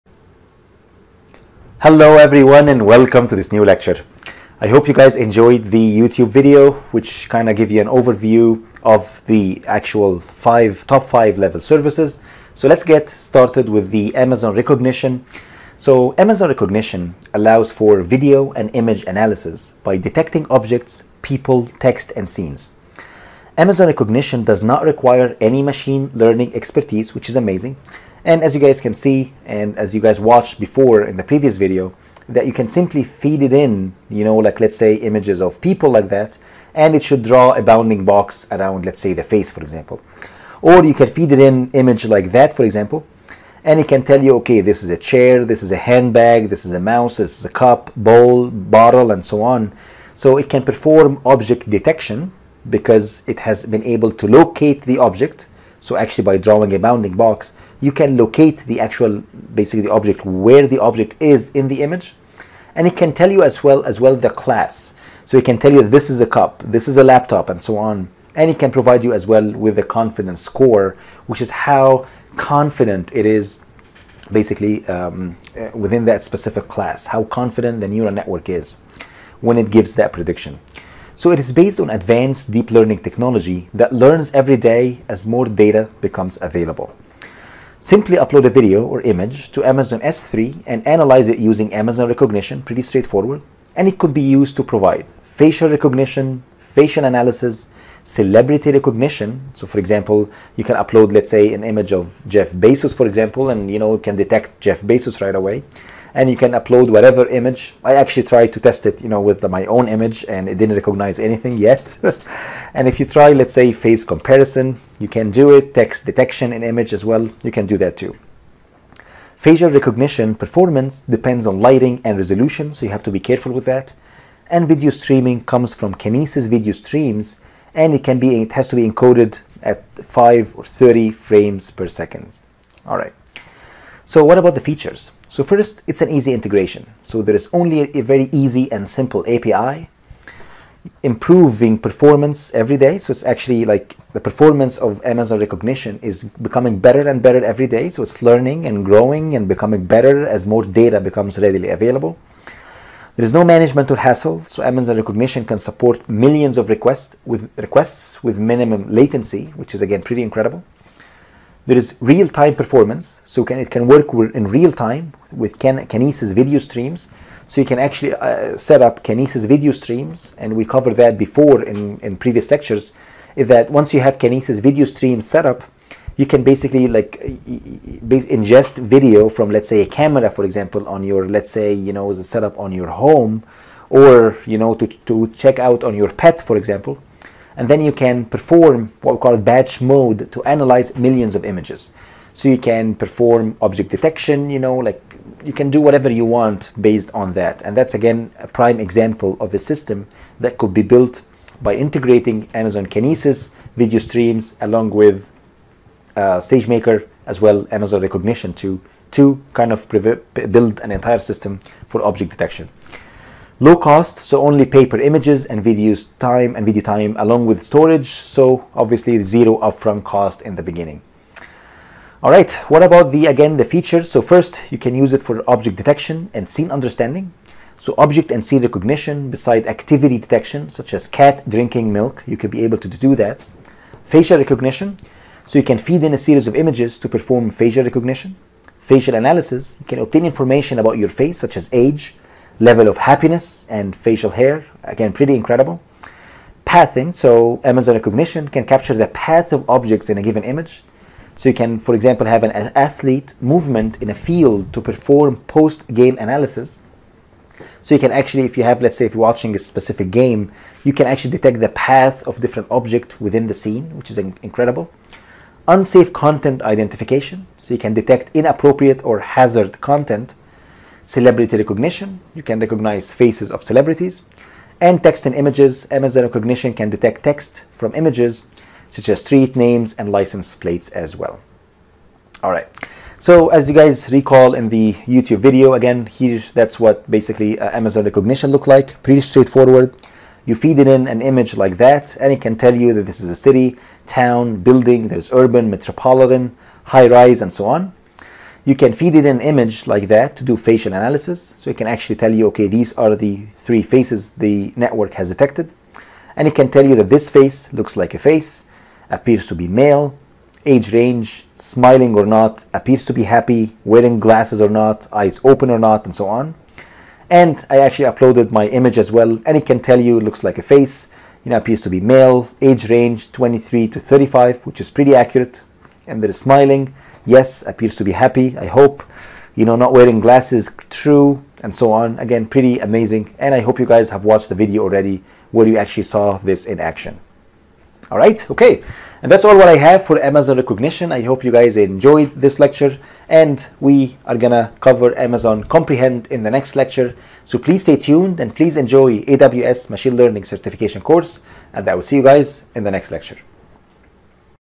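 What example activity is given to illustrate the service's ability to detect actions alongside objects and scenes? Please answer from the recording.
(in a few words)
cat drinking milk.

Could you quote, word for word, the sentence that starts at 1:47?
I actually tried to test it, you know, with the, my own image and it didn't recognize anything yet.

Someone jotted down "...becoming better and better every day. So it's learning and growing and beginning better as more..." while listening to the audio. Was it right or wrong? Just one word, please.
wrong.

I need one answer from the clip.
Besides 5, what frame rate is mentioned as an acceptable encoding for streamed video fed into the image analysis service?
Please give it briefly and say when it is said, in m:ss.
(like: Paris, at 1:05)
30 frames per second, at 2:10.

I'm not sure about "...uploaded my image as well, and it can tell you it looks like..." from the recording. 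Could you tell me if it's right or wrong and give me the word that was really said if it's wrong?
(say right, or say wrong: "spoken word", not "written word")
right.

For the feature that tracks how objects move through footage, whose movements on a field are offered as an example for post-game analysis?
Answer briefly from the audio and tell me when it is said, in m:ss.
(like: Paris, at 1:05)
athlete, at 4:12.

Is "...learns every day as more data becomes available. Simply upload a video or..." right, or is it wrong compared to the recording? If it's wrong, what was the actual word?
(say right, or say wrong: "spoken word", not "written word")
right.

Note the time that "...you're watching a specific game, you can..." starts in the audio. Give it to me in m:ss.
4:19.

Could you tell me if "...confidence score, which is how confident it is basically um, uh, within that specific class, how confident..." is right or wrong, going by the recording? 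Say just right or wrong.
right.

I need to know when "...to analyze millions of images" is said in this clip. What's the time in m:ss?
3:10.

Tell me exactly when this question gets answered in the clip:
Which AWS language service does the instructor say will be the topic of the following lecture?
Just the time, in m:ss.
5:45.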